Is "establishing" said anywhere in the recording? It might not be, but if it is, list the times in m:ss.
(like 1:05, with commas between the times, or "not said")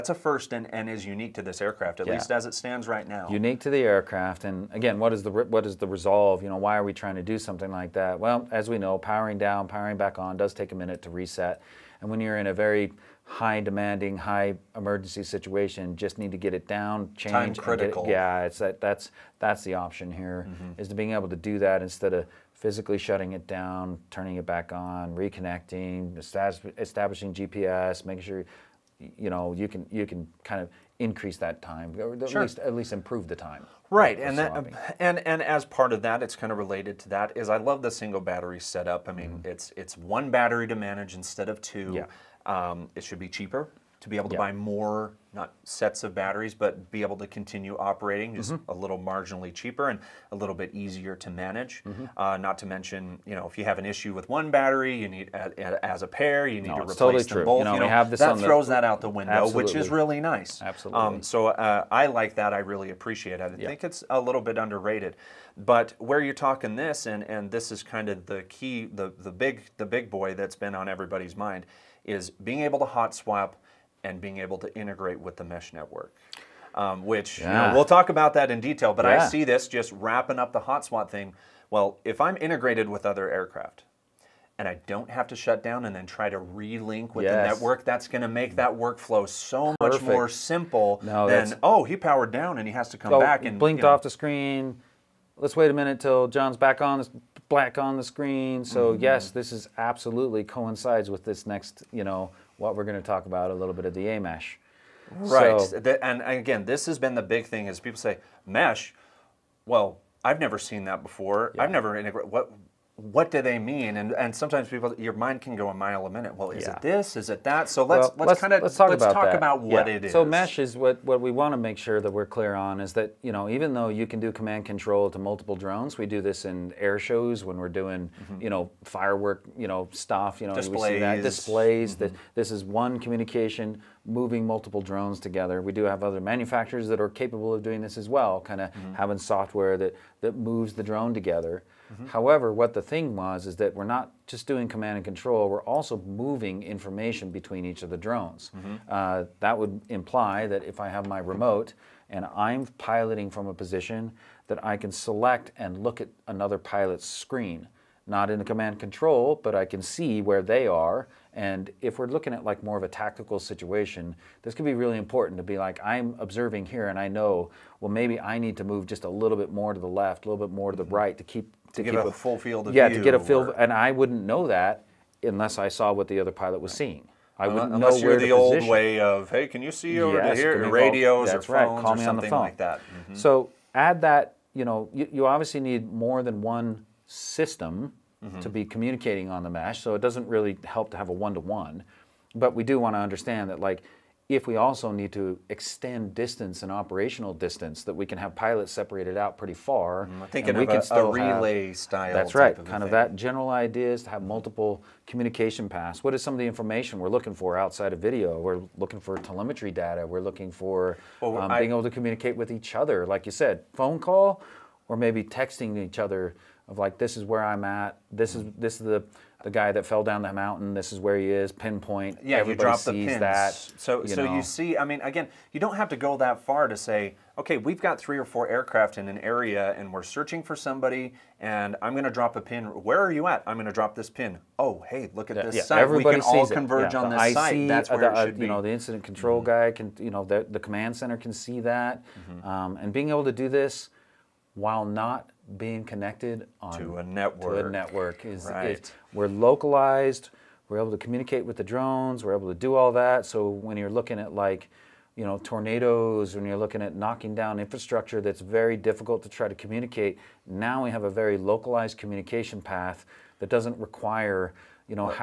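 0:26.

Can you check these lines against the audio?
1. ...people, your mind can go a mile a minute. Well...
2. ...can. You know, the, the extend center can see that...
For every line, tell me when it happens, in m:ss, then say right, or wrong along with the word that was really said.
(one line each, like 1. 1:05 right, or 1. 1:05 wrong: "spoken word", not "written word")
1. 1:54 right
2. 3:59 wrong: "command", not "extend".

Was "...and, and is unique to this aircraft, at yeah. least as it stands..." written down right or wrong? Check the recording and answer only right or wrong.
right.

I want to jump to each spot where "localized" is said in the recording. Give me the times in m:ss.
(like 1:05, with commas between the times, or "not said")
4:09, 4:21.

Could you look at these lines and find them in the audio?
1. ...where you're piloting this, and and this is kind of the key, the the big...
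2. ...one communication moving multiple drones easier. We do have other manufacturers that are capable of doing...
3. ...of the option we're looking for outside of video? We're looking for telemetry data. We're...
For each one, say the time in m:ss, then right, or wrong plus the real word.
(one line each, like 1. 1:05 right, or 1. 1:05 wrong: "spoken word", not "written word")
1. 1:06 wrong: "talking", not "piloting"
2. 2:12 wrong: "together", not "easier"
3. 3:26 wrong: "information", not "option".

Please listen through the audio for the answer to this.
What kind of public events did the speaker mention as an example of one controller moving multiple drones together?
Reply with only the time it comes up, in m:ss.
2:06.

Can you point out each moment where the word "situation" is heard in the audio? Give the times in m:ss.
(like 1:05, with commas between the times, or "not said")
0:15, 2:43.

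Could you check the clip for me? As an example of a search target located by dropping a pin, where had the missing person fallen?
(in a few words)
Down the mountain.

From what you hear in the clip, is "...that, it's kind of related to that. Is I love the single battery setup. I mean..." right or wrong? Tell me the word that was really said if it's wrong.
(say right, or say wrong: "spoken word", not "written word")
right.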